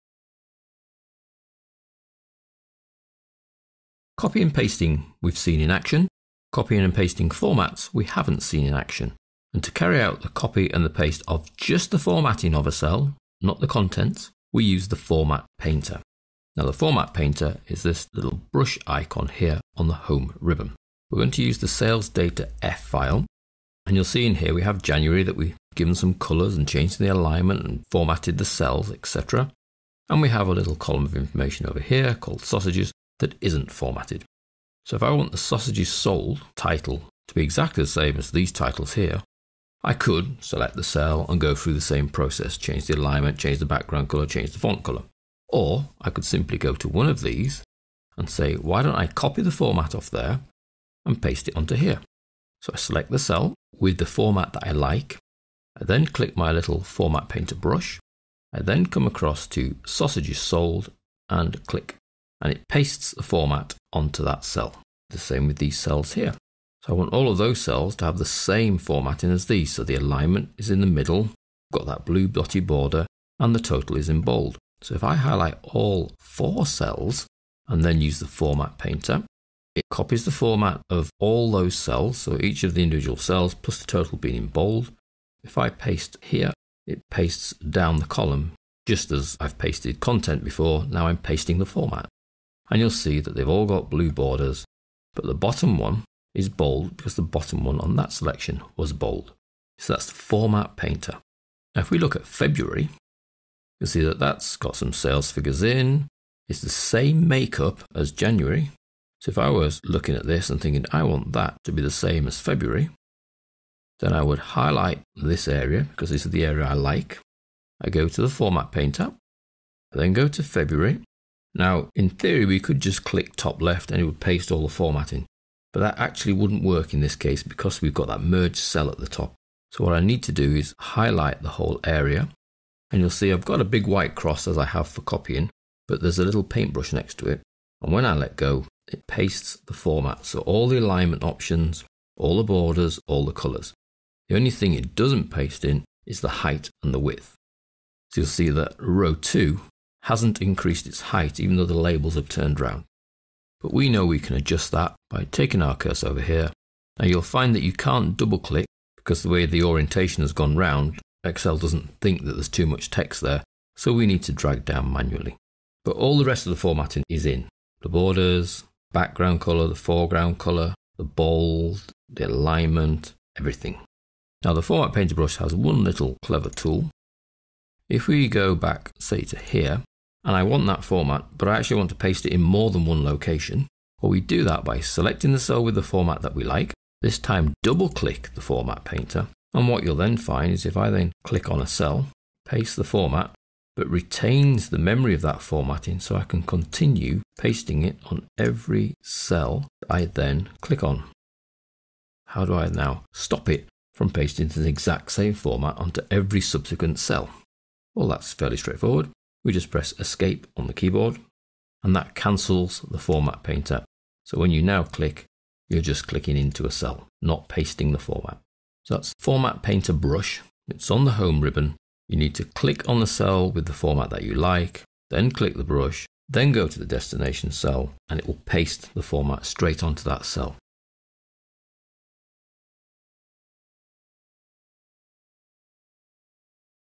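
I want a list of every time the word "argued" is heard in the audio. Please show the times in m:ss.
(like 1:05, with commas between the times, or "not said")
not said.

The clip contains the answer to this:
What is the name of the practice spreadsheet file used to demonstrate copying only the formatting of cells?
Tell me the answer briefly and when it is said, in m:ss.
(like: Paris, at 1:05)
sales data F, at 0:21.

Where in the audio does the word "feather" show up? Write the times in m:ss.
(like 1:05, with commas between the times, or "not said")
not said.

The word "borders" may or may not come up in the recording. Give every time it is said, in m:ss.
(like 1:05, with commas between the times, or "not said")
1:12, 1:34, 2:22, 2:47.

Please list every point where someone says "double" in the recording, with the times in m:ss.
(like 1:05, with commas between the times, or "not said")
2:38, 3:07.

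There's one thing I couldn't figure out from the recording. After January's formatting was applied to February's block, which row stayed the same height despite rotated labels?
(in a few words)
row 2.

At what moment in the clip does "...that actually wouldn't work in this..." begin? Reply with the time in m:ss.
2:05.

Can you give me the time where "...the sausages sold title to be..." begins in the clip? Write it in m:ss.
0:35.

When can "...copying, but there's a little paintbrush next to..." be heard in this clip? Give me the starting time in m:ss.
2:15.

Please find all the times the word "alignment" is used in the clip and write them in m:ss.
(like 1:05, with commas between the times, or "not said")
0:27, 0:42, 1:09, 2:20, 2:52.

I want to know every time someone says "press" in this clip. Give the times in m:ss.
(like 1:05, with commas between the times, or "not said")
3:29.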